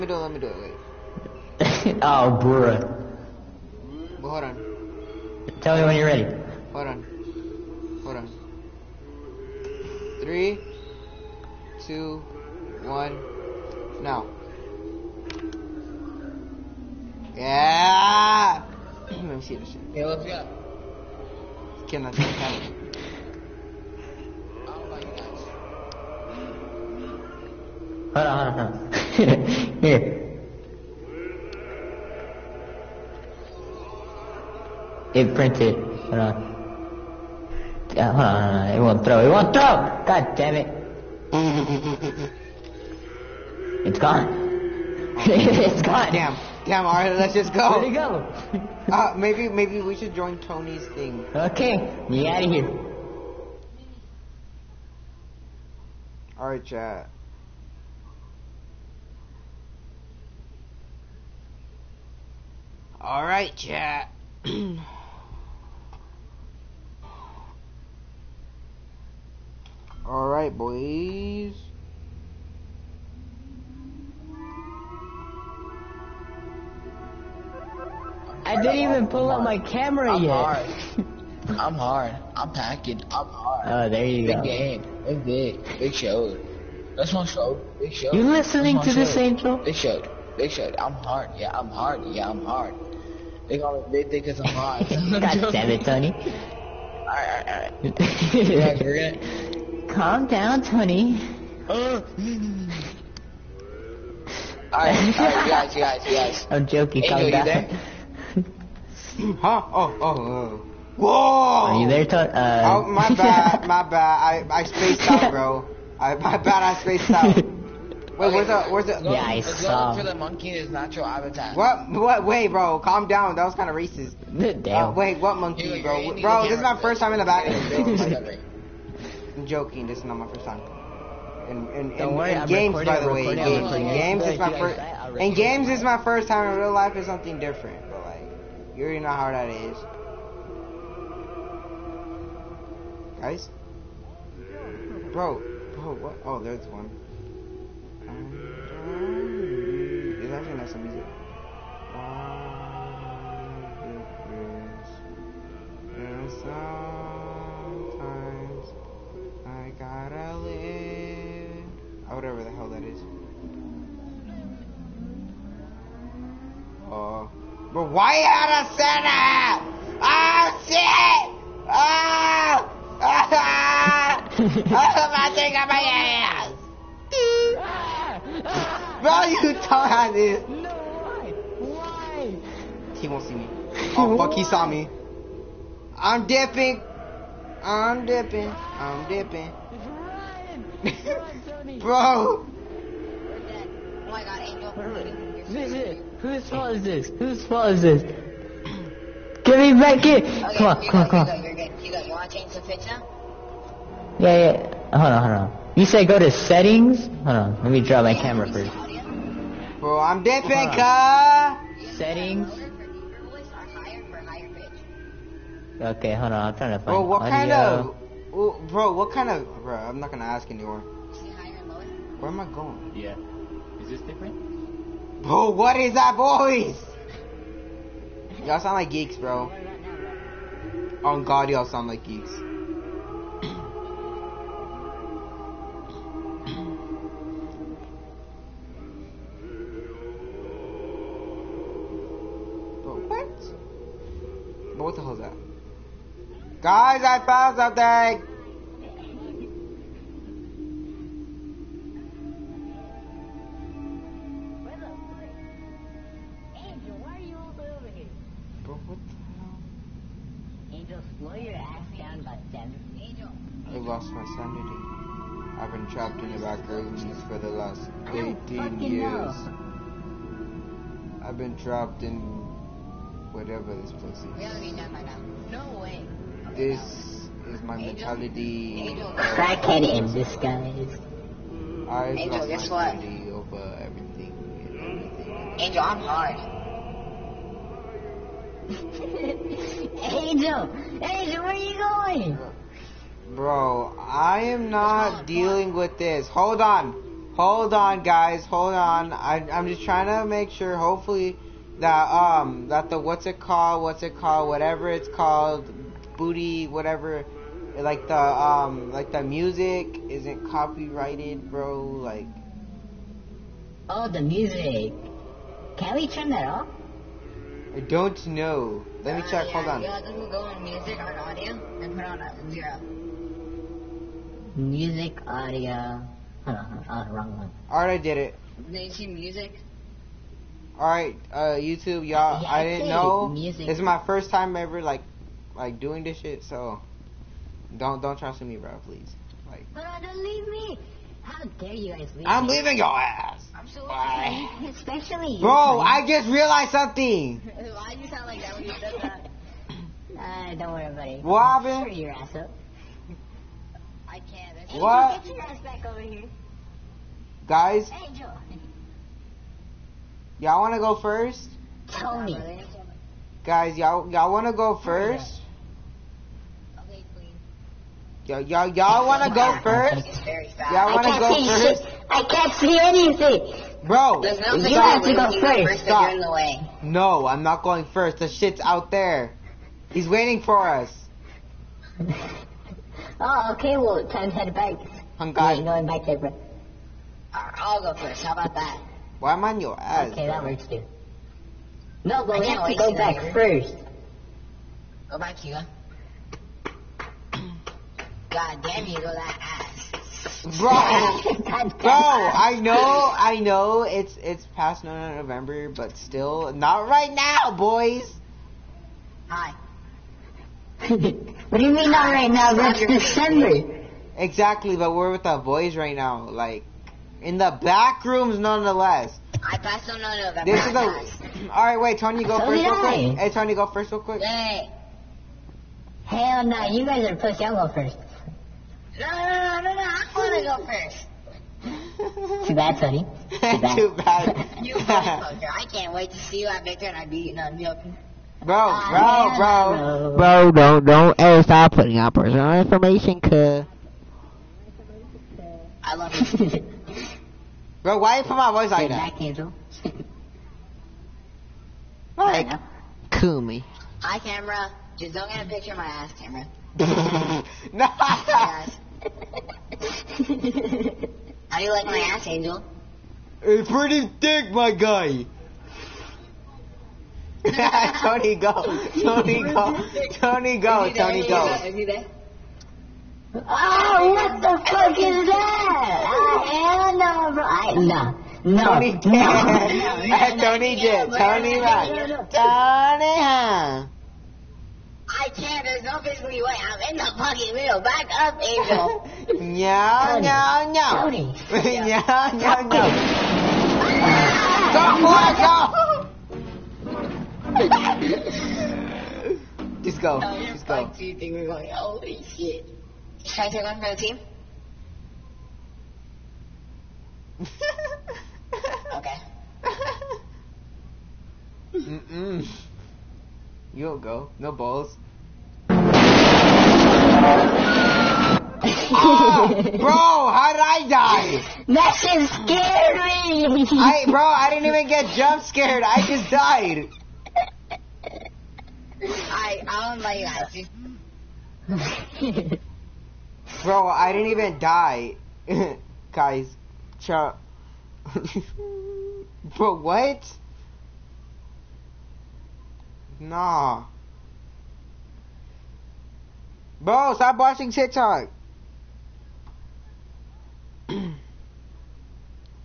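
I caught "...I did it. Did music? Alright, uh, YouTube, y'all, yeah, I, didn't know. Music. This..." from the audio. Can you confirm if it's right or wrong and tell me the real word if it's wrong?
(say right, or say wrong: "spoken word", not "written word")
right.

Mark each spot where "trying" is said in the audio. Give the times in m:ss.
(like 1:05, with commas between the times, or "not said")
3:36, 4:59.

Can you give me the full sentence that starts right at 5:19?
Yeah, this will go on music on audio and put on zero.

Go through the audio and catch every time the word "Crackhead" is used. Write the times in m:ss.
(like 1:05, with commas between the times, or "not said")
4:39.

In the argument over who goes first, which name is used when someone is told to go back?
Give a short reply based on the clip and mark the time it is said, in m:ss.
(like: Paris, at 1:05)
Hugo, at 6:35.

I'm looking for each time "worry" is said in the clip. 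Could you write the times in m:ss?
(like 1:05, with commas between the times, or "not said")
2:12, 5:50.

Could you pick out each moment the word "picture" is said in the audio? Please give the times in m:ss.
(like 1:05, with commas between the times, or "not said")
3:22, 7:35.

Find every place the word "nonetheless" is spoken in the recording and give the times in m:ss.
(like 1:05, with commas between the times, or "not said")
6:58.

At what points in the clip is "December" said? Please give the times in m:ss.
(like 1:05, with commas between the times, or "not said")
6:52.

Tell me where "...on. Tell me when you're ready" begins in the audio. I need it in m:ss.
0:04.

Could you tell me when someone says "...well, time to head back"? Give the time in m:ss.
6:23.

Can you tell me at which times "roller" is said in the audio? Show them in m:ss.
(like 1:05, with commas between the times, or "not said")
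not said.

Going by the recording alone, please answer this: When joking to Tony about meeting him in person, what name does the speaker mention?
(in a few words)
Victor.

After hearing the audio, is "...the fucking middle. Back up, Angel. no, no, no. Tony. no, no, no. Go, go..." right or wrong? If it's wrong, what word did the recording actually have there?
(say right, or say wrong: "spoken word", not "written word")
right.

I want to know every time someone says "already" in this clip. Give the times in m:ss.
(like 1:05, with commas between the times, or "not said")
2:18, 4:34.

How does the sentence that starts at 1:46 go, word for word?
I'm joking, Angel, calm down huh?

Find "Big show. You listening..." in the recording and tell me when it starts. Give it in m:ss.
1:27.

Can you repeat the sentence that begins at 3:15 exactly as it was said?
This is whose fault is this?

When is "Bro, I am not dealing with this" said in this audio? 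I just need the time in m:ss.
4:53.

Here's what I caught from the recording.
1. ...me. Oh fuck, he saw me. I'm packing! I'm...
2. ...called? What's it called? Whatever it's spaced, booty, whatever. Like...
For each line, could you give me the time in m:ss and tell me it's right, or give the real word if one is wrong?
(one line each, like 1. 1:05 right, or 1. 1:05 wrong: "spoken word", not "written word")
1. 3:03 wrong: "dipping", not "packing"
2. 5:03 wrong: "called", not "spaced".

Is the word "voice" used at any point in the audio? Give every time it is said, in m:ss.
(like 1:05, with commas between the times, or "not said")
3:46, 7:28.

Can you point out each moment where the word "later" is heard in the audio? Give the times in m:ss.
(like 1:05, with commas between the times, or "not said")
6:33.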